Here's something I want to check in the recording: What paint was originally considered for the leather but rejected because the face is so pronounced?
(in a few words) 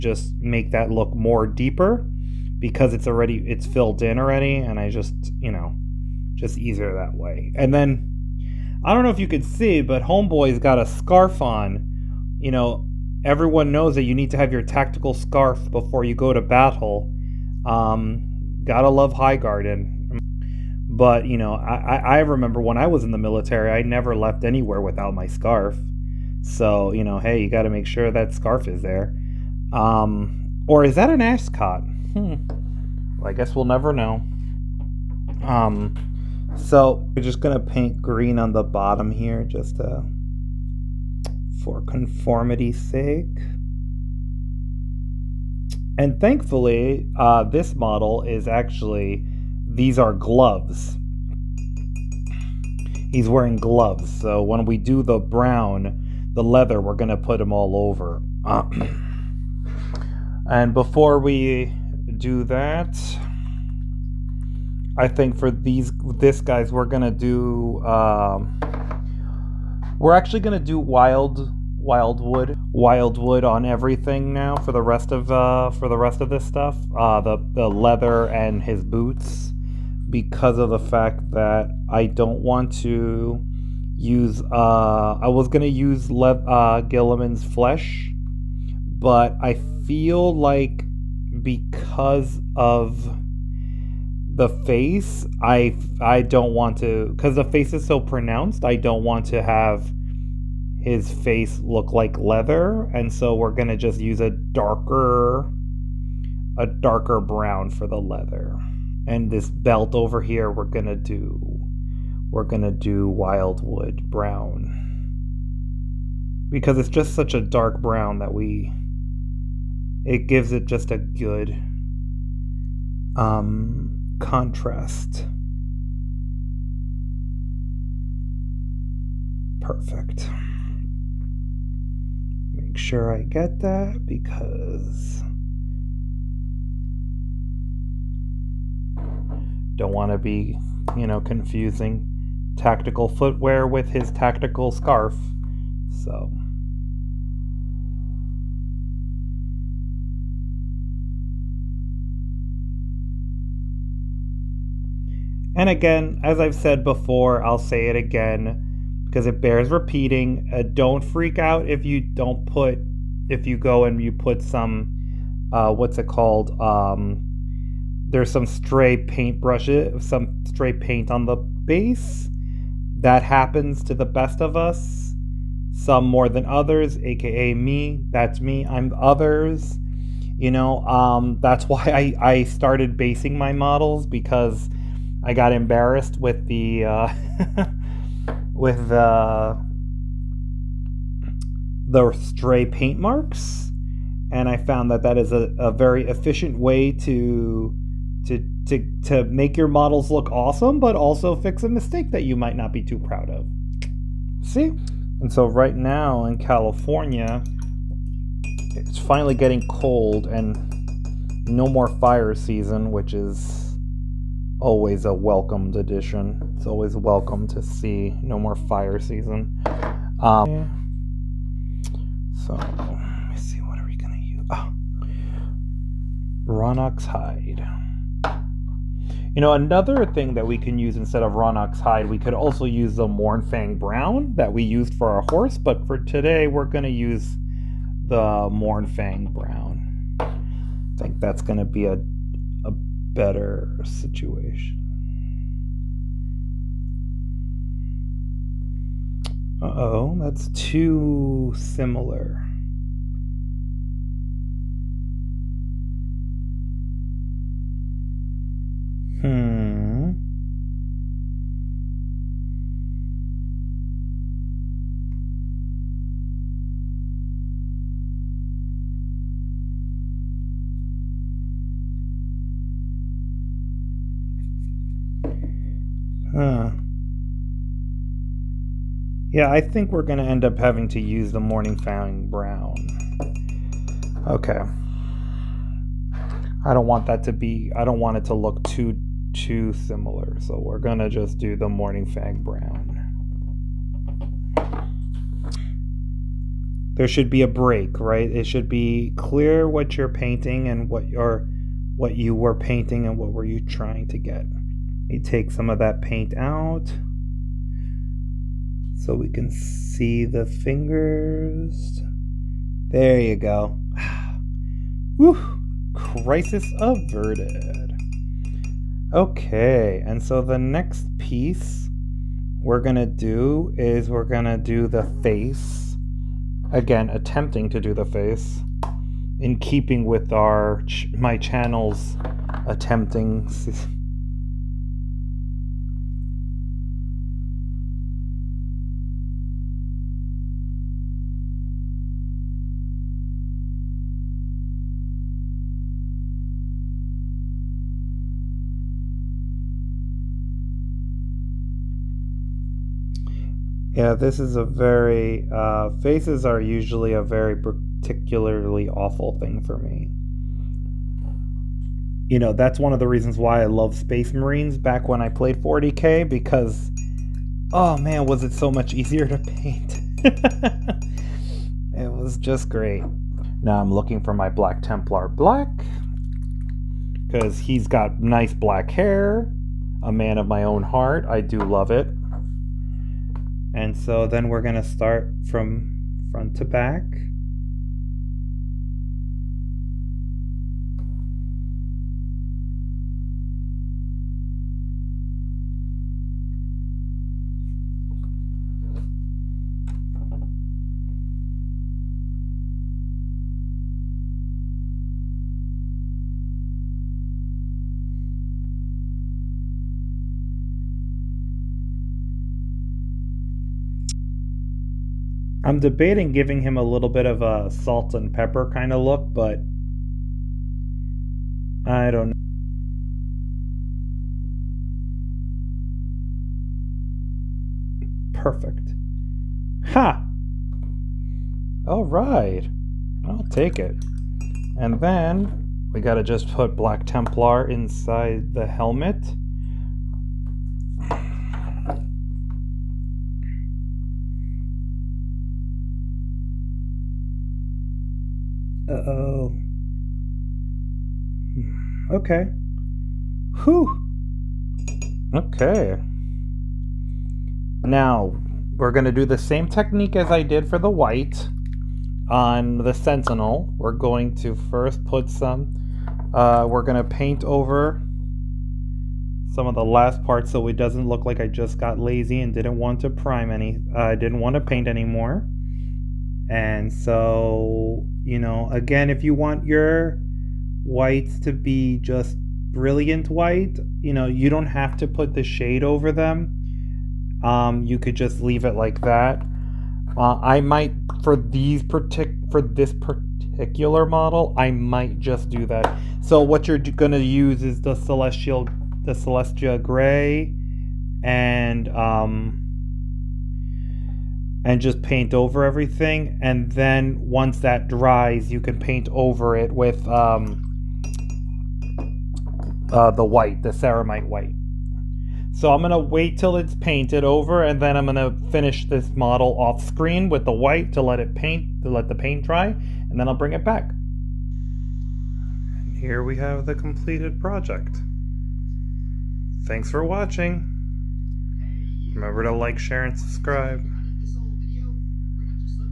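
Guilliman's flesh.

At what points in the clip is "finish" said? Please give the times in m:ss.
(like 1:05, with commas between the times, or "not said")
8:38.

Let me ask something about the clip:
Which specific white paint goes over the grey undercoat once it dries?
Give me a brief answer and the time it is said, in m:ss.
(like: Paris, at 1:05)
Ceramite white, at 8:33.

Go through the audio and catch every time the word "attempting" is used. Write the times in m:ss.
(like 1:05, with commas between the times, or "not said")
5:27, 5:32.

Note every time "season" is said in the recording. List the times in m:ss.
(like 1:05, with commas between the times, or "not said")
3:32, 3:38.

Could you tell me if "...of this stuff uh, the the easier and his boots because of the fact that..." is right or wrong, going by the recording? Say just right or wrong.
wrong.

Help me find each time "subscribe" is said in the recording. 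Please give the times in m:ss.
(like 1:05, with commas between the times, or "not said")
8:53.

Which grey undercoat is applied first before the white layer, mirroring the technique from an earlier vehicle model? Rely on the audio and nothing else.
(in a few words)
Celestra gray.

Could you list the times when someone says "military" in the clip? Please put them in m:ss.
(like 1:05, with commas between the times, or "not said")
0:23.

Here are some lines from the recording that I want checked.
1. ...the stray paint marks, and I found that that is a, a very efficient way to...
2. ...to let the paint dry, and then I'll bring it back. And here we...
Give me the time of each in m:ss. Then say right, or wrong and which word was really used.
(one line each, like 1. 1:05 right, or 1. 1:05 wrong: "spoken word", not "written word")
1. 3:11 right
2. 8:41 right.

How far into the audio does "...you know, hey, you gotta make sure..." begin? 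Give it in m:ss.
0:26.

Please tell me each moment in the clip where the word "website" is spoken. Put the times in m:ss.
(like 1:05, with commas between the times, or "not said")
not said.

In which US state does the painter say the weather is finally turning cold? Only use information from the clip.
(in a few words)
California.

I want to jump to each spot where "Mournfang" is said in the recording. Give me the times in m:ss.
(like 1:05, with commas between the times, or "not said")
3:53, 3:58.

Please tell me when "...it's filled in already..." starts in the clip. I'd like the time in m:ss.
0:03.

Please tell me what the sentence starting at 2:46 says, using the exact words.
Um, there's some stray paint brushes, some stray paint on the base.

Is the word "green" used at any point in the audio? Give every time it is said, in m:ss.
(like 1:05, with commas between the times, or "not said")
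0:37.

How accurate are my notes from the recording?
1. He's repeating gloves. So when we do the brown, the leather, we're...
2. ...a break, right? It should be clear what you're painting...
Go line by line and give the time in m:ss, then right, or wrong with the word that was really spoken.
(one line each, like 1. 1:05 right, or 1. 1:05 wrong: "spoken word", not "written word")
1. 0:53 wrong: "wearing", not "repeating"
2. 4:57 right.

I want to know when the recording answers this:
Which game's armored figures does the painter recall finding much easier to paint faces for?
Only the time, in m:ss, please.
6:05.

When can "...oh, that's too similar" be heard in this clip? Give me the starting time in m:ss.
4:09.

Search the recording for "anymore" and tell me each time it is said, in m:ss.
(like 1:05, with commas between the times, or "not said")
7:54.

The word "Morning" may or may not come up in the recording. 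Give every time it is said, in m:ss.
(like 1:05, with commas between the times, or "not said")
4:41, 4:51.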